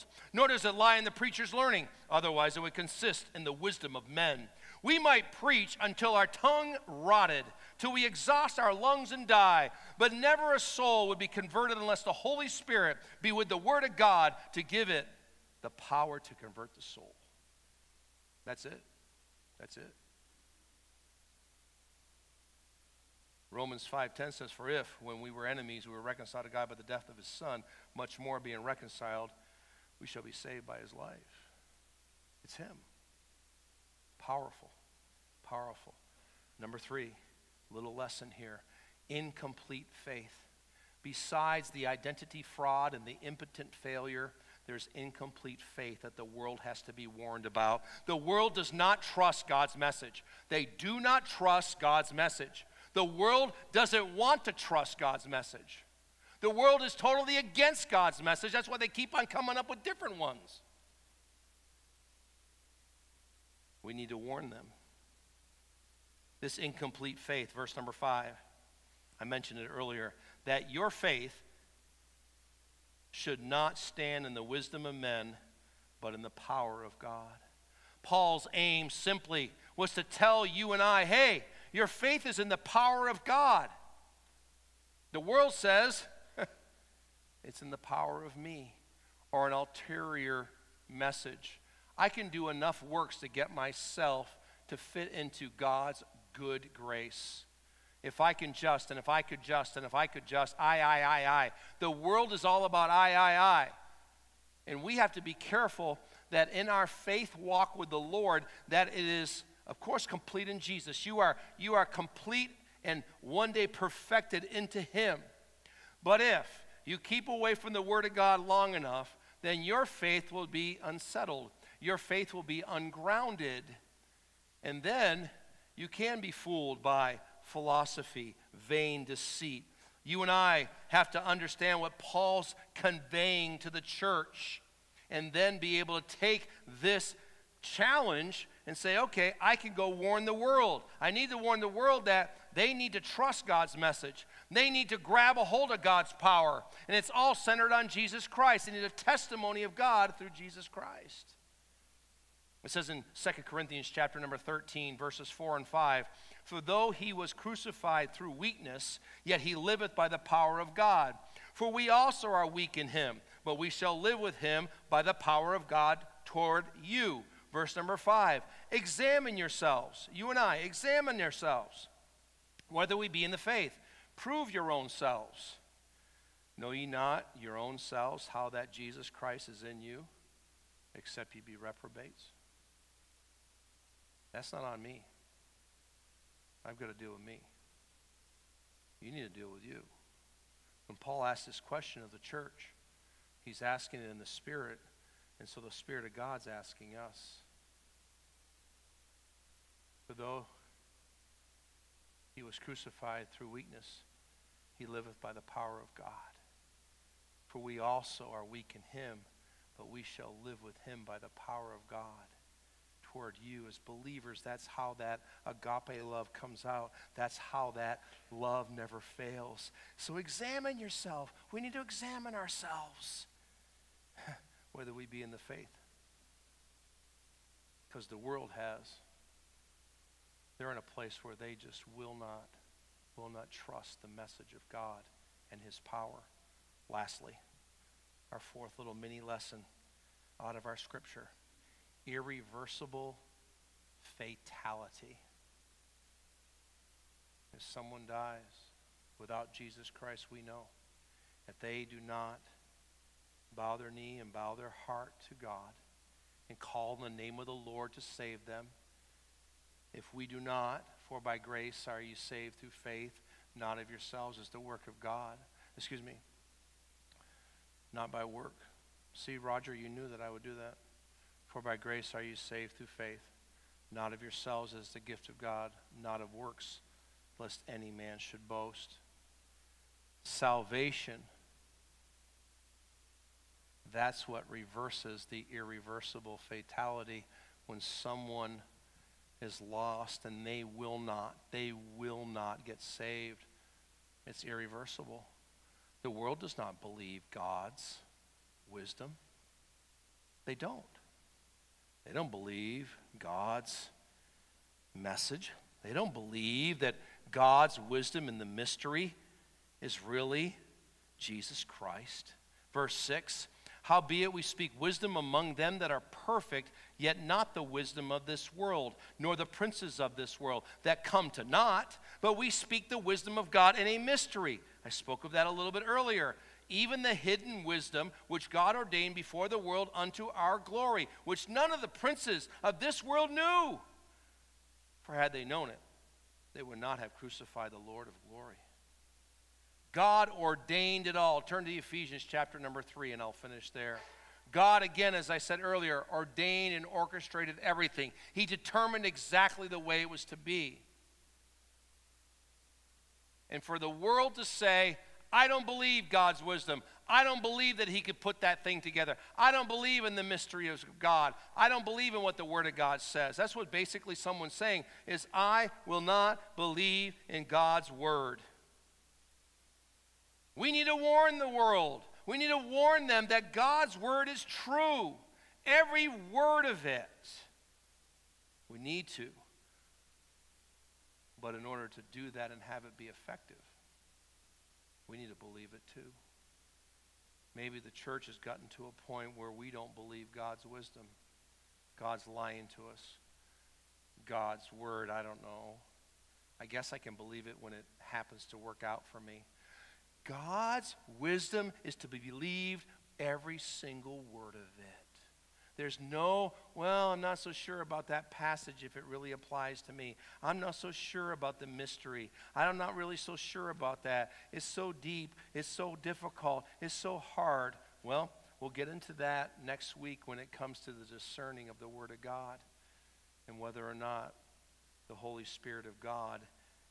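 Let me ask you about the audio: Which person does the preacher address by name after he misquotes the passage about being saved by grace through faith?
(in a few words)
Roger.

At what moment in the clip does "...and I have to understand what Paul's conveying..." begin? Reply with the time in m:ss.
2:10.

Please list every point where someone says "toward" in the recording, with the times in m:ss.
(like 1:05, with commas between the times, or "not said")
2:46, 3:33.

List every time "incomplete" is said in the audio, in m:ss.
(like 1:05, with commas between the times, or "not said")
0:39, 0:44, 1:06.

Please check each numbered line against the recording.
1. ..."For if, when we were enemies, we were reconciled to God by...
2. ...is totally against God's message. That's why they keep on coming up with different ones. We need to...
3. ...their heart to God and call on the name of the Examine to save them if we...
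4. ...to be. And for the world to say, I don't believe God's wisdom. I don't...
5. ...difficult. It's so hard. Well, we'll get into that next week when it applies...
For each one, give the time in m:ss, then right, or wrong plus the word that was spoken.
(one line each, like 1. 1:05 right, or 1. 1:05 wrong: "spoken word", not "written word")
1. 0:24 right
2. 0:56 right
3. 4:14 wrong: "Lord", not "Examine"
4. 5:50 right
5. 6:56 wrong: "comes", not "applies".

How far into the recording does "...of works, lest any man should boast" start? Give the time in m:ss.
4:36.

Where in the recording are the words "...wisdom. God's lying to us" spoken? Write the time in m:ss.
6:30.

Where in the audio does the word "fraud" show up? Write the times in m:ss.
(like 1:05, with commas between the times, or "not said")
0:42.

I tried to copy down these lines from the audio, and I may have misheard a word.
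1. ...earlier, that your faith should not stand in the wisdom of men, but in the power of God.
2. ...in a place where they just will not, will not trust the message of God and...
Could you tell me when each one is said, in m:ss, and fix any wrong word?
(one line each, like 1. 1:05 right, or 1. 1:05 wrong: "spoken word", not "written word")
1. 1:09 right
2. 3:50 right.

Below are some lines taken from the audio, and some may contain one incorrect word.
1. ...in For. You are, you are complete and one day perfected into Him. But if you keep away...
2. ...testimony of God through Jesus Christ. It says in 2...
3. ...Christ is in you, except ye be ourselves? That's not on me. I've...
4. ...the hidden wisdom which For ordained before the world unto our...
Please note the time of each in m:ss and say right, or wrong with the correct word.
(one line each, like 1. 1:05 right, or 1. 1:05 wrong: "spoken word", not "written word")
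1. 1:50 wrong: "Jesus", not "For"
2. 2:28 right
3. 2:59 wrong: "reprobates", not "ourselves"
4. 5:27 wrong: "God", not "For".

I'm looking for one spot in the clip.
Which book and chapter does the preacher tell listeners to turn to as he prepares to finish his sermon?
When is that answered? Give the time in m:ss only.
5:41.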